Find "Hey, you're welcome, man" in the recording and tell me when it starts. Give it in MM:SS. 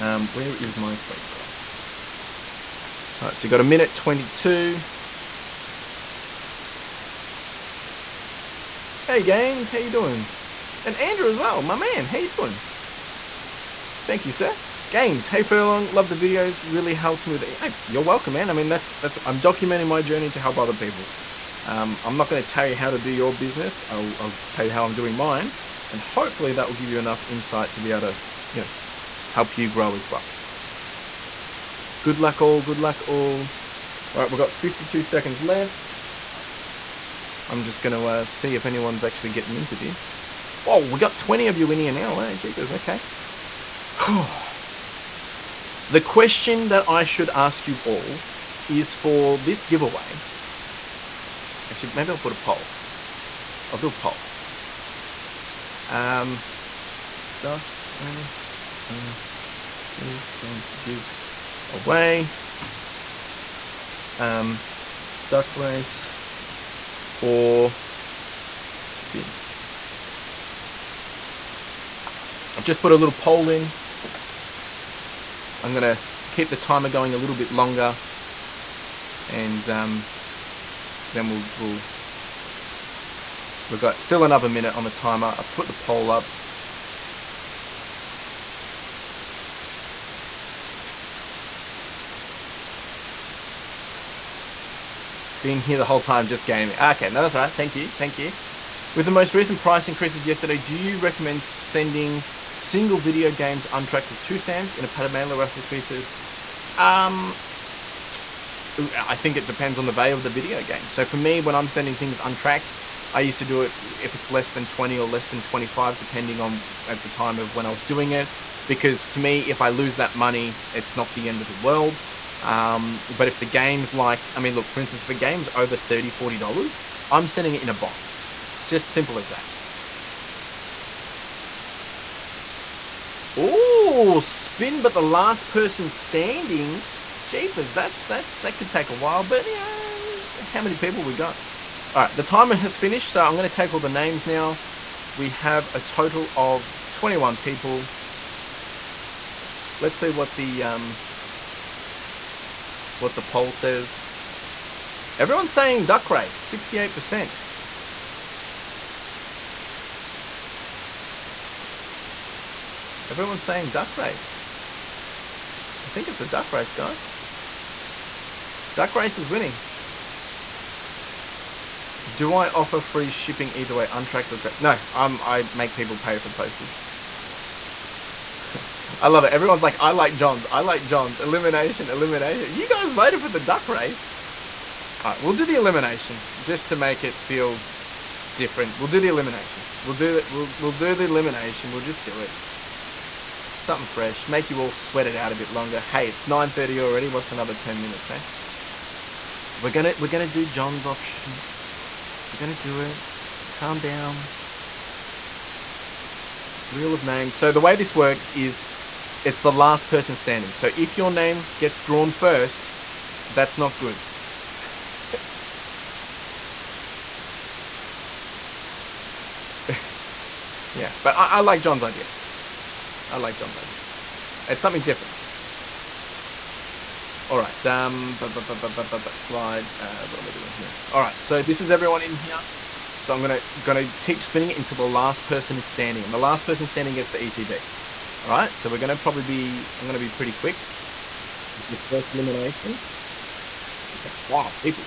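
00:17.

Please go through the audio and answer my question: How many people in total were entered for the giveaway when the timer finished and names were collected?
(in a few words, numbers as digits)
21.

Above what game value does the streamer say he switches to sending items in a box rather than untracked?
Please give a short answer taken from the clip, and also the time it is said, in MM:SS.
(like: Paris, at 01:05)
$30, at 02:05.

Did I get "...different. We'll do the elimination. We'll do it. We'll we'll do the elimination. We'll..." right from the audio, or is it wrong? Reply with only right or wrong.
right.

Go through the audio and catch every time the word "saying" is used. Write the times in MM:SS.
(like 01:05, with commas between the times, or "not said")
02:35, 02:43.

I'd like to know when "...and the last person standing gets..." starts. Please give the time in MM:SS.
03:56.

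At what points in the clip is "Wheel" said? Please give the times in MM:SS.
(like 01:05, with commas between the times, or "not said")
03:26.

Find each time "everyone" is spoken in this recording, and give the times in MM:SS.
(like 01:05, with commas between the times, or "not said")
02:35, 02:43, 02:59, 03:51.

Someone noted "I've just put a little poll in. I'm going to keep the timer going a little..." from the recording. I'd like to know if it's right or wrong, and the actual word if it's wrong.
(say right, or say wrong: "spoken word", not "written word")
right.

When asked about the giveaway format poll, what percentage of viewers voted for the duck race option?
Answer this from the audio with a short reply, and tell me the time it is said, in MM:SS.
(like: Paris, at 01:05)
68%, at 02:36.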